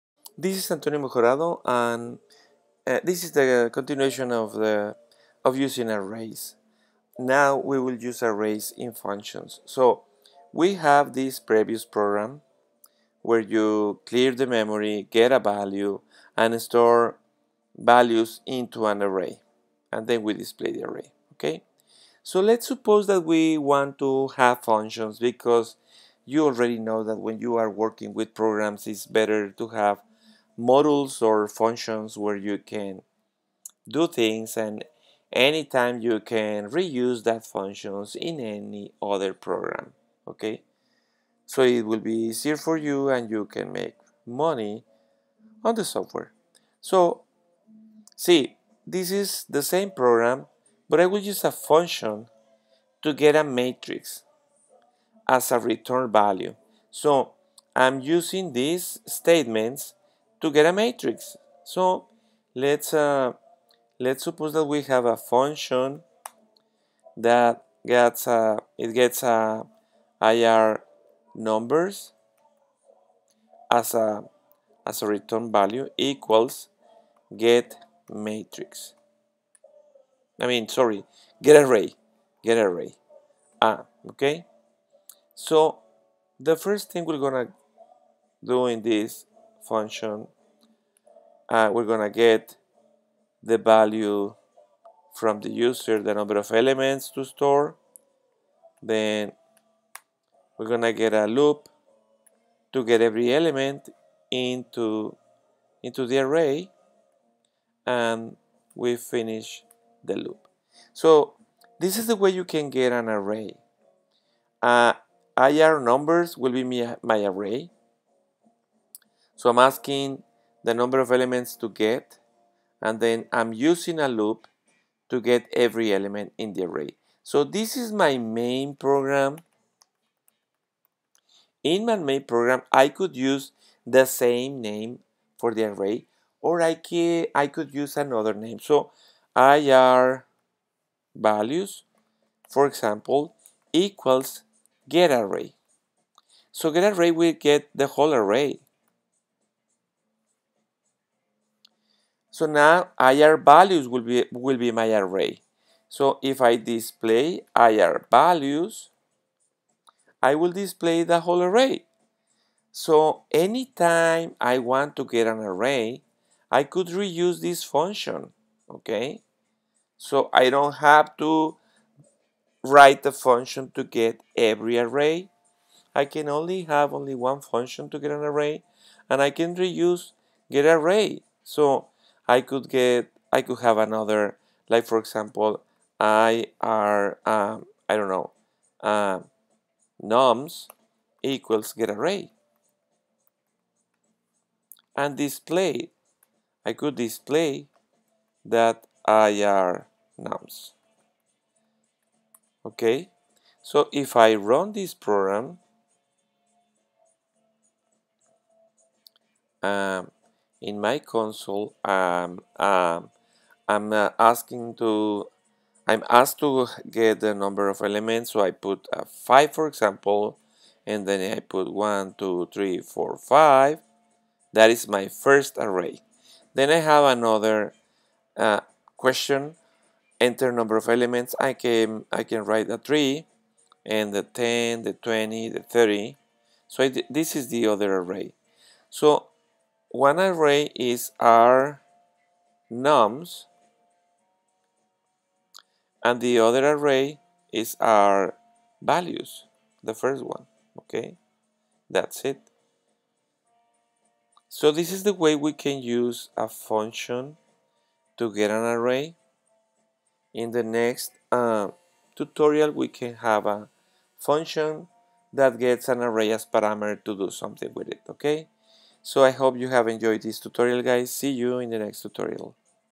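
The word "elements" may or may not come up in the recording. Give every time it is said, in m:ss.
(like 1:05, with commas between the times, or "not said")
1:36, 1:43, 2:01, 2:05, 3:37, 3:50.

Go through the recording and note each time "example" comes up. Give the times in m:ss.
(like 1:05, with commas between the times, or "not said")
2:22, 3:04, 3:39.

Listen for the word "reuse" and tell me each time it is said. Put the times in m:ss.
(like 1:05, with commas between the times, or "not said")
0:36, 2:46, 2:59.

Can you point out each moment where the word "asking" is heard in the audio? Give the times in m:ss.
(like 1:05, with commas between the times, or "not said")
1:59, 3:34.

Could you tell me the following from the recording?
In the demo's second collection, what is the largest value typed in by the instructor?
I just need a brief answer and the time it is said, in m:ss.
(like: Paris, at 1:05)
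30, at 3:55.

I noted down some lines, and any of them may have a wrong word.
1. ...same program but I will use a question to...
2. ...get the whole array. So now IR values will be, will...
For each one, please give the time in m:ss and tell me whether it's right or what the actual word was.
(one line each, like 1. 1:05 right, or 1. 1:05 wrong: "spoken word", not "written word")
1. 0:49 wrong: "function", not "question"
2. 2:27 right.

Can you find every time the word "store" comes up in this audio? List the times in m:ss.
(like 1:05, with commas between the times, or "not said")
0:16, 1:37.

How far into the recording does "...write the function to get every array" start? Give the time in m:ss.
2:52.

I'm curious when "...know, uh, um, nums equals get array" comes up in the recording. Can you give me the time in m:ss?
3:08.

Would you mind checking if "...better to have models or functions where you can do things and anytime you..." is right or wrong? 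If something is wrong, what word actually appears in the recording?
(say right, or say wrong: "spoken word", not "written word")
right.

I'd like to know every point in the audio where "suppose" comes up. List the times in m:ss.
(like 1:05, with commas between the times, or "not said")
0:22, 1:04.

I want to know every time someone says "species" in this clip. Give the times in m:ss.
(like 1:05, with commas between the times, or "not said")
not said.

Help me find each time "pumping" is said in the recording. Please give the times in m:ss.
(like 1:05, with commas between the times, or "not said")
not said.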